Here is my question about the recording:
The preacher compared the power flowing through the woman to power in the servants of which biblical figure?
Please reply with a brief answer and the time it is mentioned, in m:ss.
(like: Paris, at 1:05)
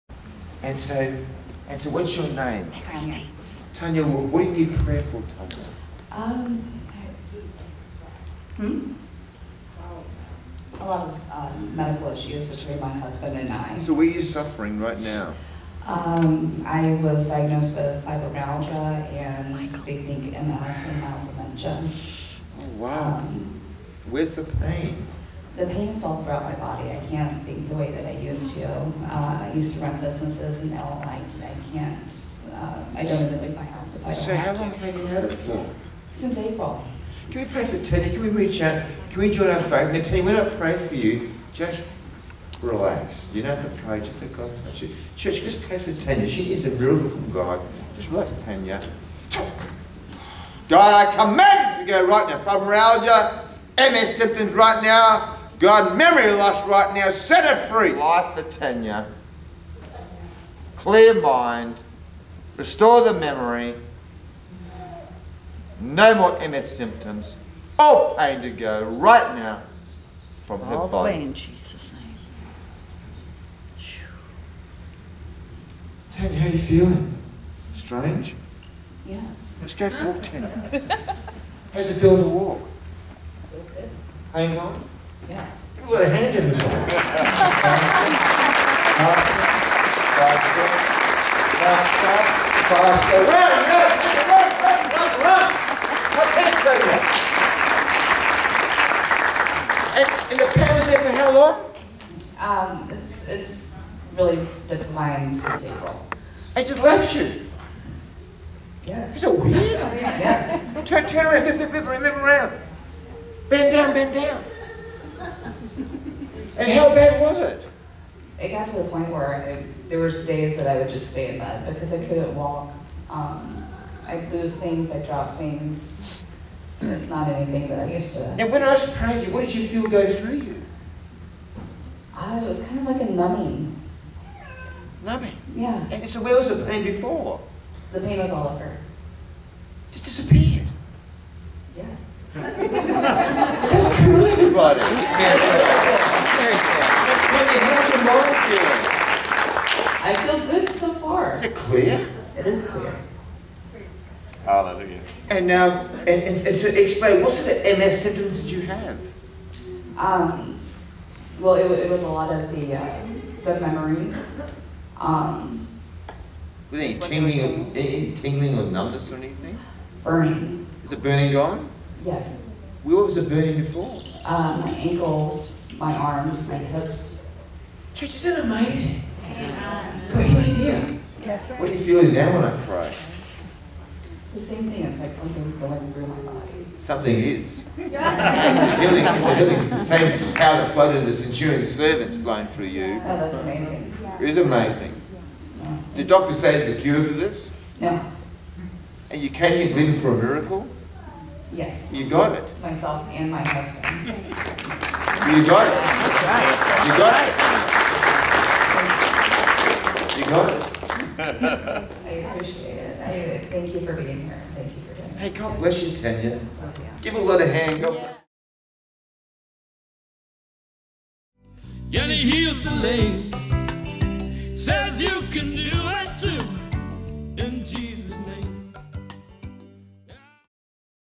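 the centurion, at 3:11.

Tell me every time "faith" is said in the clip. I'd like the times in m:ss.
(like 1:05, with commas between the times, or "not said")
0:39.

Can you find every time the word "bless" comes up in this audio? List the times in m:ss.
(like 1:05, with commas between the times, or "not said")
3:35.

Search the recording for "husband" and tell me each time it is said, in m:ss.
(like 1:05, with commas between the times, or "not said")
0:12, 3:23.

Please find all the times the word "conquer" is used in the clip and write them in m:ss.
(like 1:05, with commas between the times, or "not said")
not said.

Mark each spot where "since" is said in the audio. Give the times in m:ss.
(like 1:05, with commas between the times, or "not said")
0:36, 1:45.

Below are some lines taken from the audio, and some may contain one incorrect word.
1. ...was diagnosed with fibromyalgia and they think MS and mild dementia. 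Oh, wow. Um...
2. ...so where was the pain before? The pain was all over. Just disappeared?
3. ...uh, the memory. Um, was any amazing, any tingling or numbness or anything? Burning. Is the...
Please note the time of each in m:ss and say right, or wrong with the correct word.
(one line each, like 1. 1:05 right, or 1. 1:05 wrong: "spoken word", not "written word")
1. 0:16 right
2. 2:16 right
3. 2:42 wrong: "tingling", not "amazing".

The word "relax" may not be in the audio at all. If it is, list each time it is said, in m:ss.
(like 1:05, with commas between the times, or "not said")
0:42, 0:48.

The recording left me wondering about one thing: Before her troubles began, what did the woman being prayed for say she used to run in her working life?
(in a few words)
businesses.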